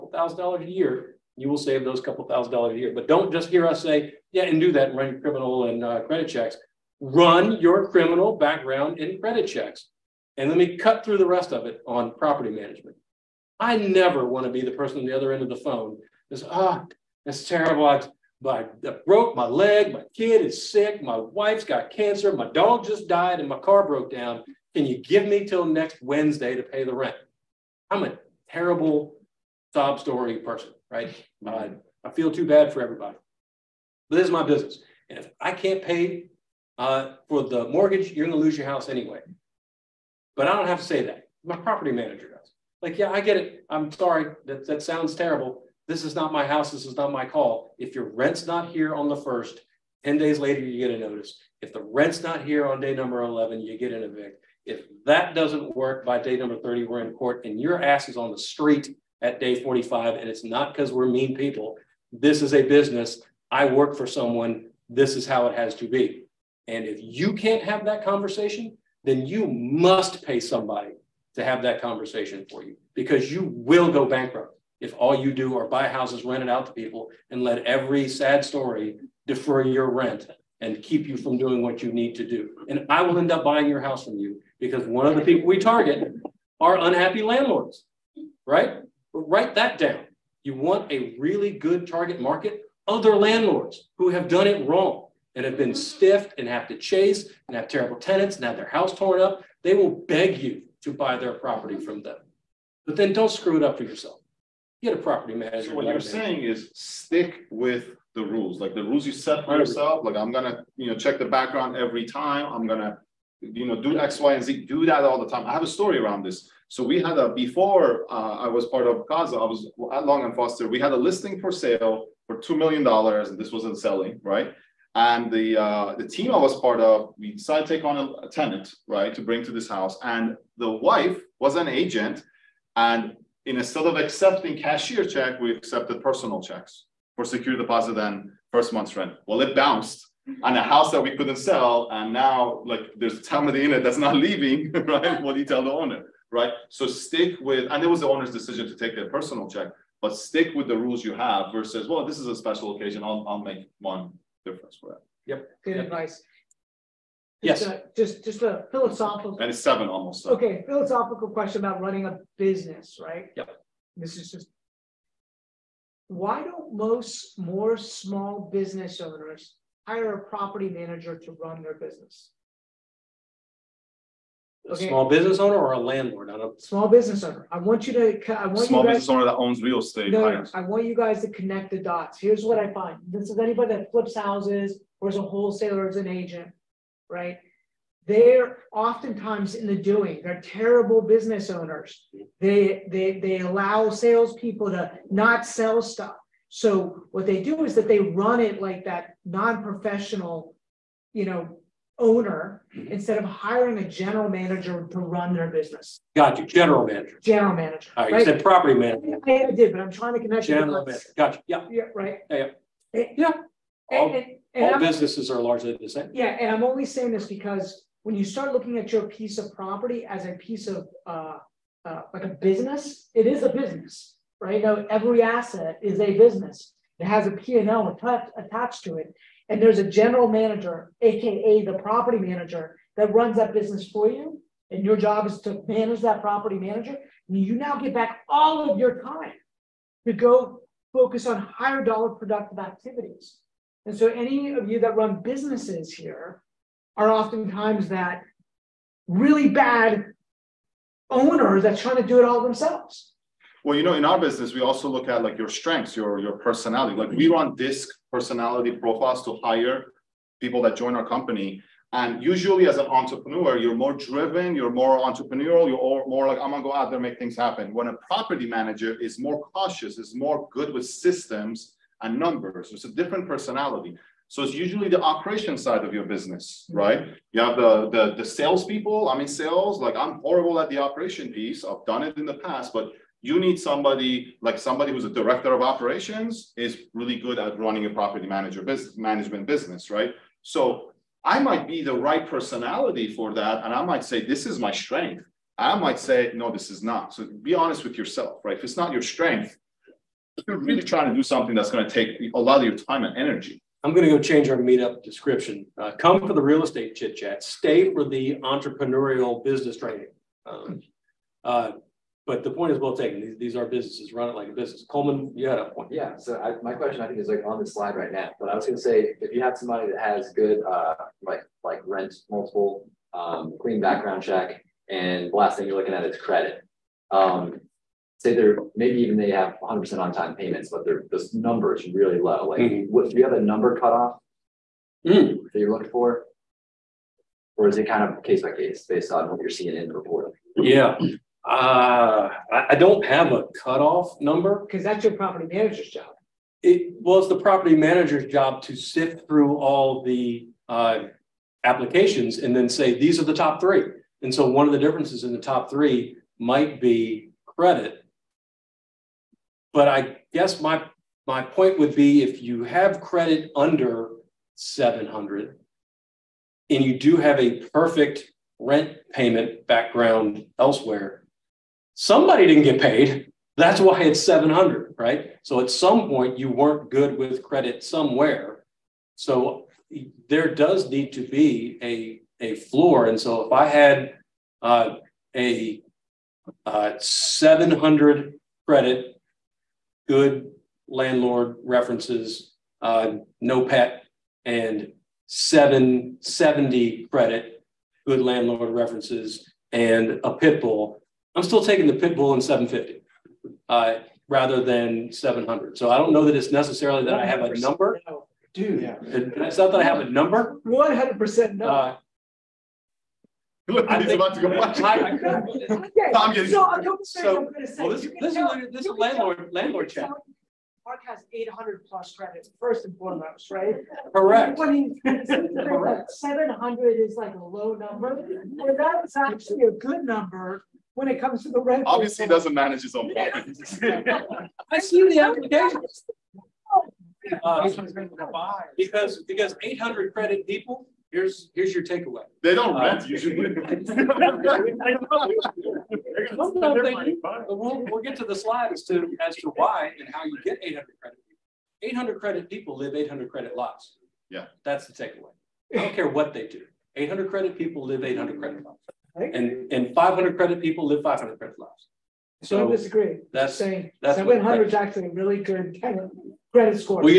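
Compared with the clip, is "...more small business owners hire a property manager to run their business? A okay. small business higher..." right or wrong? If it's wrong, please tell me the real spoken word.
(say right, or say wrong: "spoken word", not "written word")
wrong: "owner", not "higher".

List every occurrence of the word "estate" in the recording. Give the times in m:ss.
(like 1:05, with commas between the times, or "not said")
2:59, 5:06.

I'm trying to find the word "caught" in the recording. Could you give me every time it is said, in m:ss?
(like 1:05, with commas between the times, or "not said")
not said.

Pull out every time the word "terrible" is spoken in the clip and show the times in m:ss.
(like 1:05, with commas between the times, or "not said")
0:17, 0:28, 0:45, 1:37, 3:10.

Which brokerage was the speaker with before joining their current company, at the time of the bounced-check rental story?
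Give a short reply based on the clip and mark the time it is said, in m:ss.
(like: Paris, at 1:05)
Long and Foster, at 2:00.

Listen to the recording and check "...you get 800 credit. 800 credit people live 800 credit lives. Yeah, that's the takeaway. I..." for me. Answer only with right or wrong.
right.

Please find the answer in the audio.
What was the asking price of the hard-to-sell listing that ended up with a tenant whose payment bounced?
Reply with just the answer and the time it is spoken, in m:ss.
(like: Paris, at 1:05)
$2 million, at 2:02.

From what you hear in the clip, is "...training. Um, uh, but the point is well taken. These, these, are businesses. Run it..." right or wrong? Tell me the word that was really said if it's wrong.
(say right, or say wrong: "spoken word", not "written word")
right.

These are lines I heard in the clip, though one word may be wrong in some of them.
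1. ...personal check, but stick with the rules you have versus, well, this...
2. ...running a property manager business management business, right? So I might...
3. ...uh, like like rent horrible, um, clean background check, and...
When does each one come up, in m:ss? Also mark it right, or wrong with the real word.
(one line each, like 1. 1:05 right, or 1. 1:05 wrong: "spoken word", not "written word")
1. 2:29 right
2. 4:47 right
3. 5:20 wrong: "multiple", not "horrible".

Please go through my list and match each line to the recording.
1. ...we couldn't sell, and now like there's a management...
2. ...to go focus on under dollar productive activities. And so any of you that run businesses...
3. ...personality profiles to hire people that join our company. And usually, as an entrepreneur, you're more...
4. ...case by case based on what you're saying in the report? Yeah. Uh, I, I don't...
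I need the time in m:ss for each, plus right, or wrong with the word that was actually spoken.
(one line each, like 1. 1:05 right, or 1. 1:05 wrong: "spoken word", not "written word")
1. 2:21 wrong: "tenant", not "management"
2. 4:00 wrong: "higher", not "under"
3. 4:18 right
4. 5:38 wrong: "seeing", not "saying".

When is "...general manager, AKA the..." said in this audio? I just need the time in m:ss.
3:49.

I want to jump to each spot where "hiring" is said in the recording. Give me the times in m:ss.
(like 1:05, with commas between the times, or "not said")
3:23.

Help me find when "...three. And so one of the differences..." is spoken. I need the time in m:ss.
5:53.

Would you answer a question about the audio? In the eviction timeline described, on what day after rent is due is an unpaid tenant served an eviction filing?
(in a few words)
day 11.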